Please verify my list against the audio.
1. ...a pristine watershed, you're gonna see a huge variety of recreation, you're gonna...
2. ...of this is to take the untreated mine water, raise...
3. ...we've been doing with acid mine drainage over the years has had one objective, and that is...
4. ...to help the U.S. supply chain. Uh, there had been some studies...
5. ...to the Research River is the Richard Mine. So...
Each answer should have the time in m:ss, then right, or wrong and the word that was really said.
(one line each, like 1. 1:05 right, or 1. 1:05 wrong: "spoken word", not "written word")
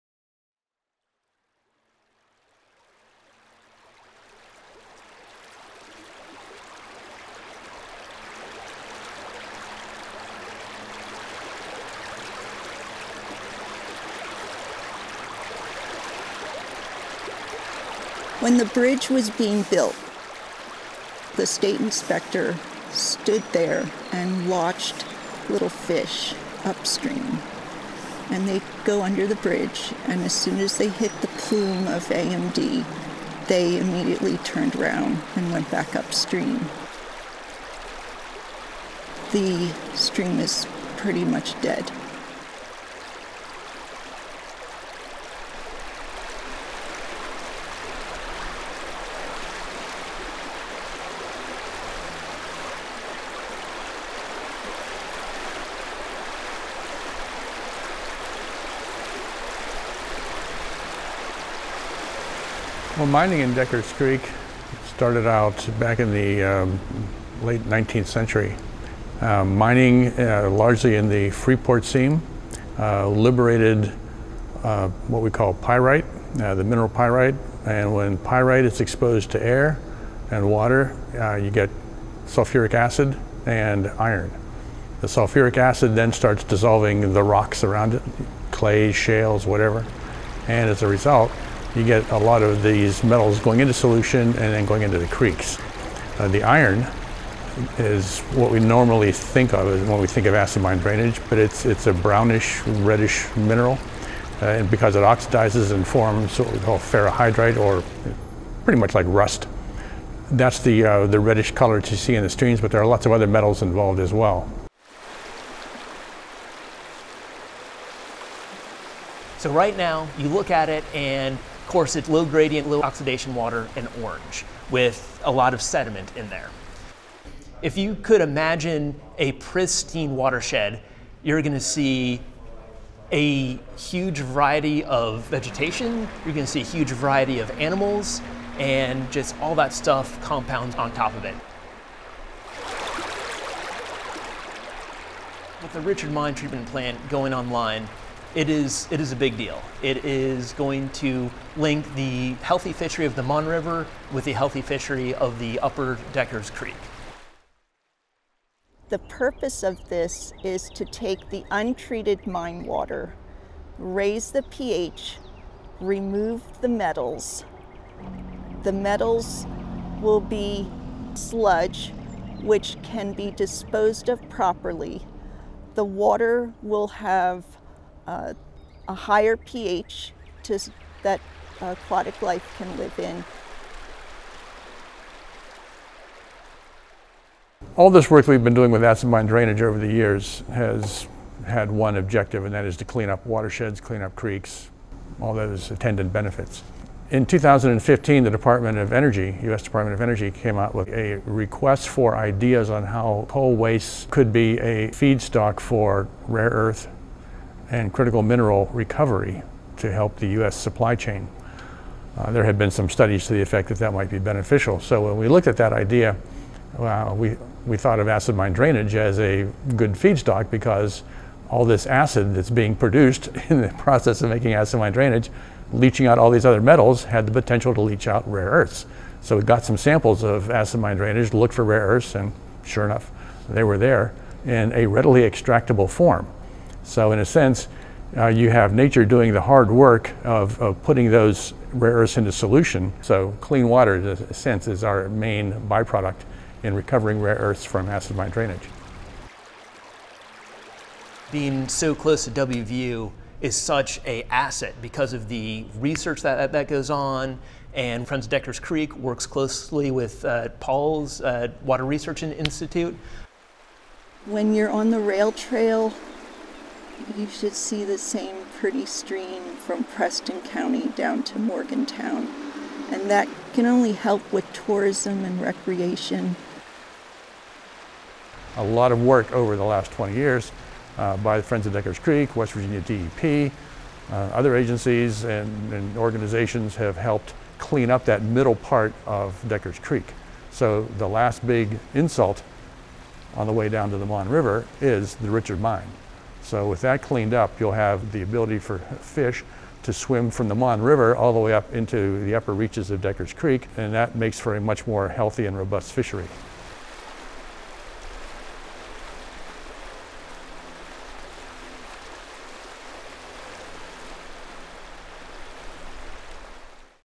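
1. 2:09 wrong: "vegetation", not "recreation"
2. 2:39 right
3. 3:08 right
4. 3:29 right
5. 4:53 wrong: "Mon", not "Research".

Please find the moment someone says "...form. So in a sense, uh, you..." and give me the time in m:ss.
3:55.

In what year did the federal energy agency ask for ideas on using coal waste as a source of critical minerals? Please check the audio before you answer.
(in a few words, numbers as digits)
2015.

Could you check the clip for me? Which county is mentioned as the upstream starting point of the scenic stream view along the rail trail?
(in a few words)
Preston County.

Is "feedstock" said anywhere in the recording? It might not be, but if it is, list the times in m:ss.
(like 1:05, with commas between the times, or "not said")
3:24, 3:39.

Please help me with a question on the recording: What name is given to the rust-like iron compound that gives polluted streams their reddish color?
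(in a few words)
ferrihydrite.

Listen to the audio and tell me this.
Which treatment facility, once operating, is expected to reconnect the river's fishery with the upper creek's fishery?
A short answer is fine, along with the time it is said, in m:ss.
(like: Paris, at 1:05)
Richard Mine treatment plant, at 2:25.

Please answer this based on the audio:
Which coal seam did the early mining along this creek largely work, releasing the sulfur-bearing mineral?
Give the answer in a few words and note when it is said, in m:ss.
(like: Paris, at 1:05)
Freeport seam, at 1:11.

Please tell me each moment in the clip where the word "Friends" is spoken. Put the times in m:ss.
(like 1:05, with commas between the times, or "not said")
4:18, 4:41.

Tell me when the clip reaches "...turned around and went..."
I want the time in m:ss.
0:34.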